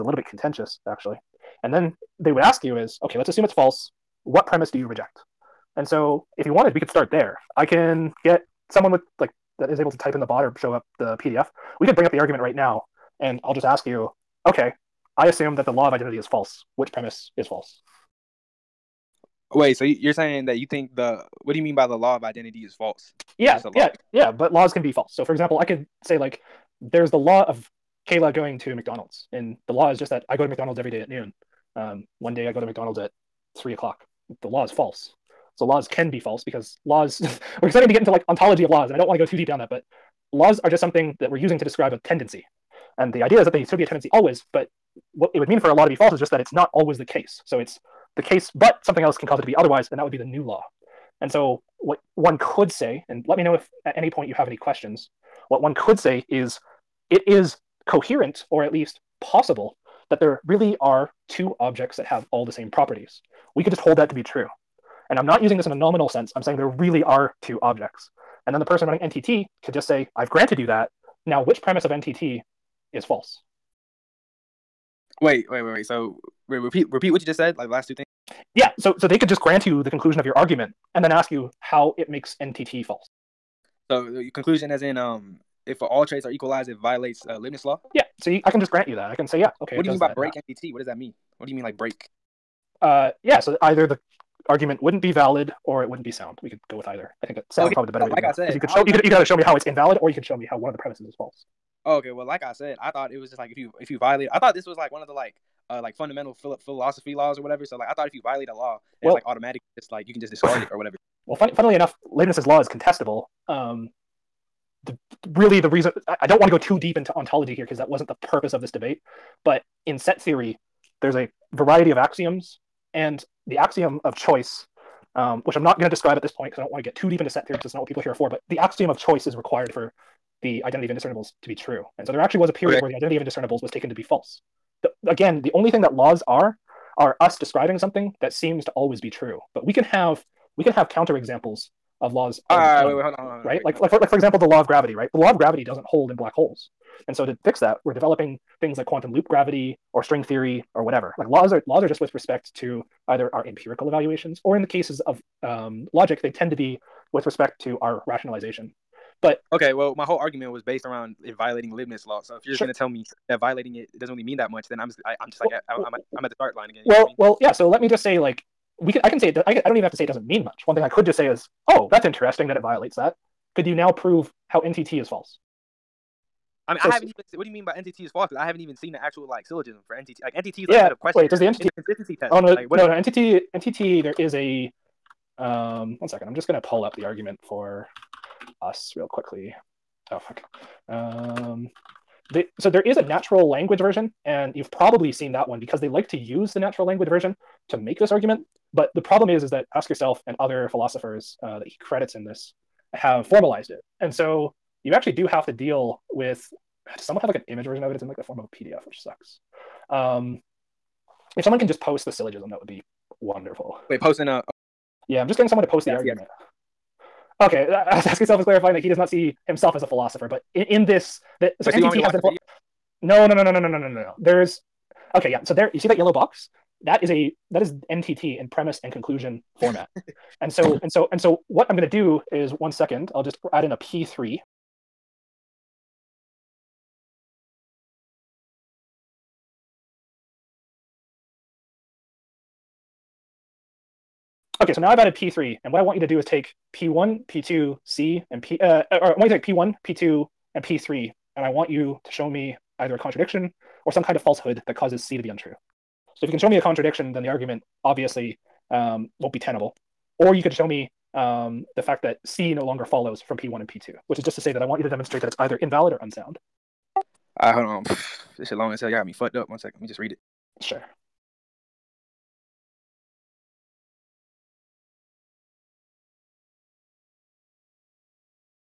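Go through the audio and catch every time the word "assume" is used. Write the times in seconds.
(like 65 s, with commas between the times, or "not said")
3 s, 15 s.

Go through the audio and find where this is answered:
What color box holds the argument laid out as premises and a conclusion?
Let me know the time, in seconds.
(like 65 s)
225 s.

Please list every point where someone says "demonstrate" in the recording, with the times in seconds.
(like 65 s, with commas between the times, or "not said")
264 s.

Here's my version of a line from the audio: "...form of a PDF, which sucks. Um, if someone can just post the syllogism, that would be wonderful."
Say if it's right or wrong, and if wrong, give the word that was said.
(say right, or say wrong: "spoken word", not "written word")
right.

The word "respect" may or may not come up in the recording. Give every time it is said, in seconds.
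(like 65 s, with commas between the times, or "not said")
152 s, 157 s.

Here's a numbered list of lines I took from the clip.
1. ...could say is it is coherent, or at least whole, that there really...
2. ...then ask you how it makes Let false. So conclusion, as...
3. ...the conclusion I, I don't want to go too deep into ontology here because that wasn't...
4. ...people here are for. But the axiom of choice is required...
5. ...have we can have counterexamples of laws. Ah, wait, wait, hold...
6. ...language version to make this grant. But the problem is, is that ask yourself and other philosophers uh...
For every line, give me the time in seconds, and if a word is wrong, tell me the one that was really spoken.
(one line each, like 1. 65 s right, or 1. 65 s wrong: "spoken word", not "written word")
1. 55 s wrong: "possible", not "whole"
2. 81 s wrong: "NTT", not "Let"
3. 115 s wrong: "reason", not "conclusion"
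4. 127 s right
5. 139 s right
6. 196 s wrong: "argument", not "grant".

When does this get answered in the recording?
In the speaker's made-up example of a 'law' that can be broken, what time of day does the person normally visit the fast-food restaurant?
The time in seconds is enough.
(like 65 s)
31 s.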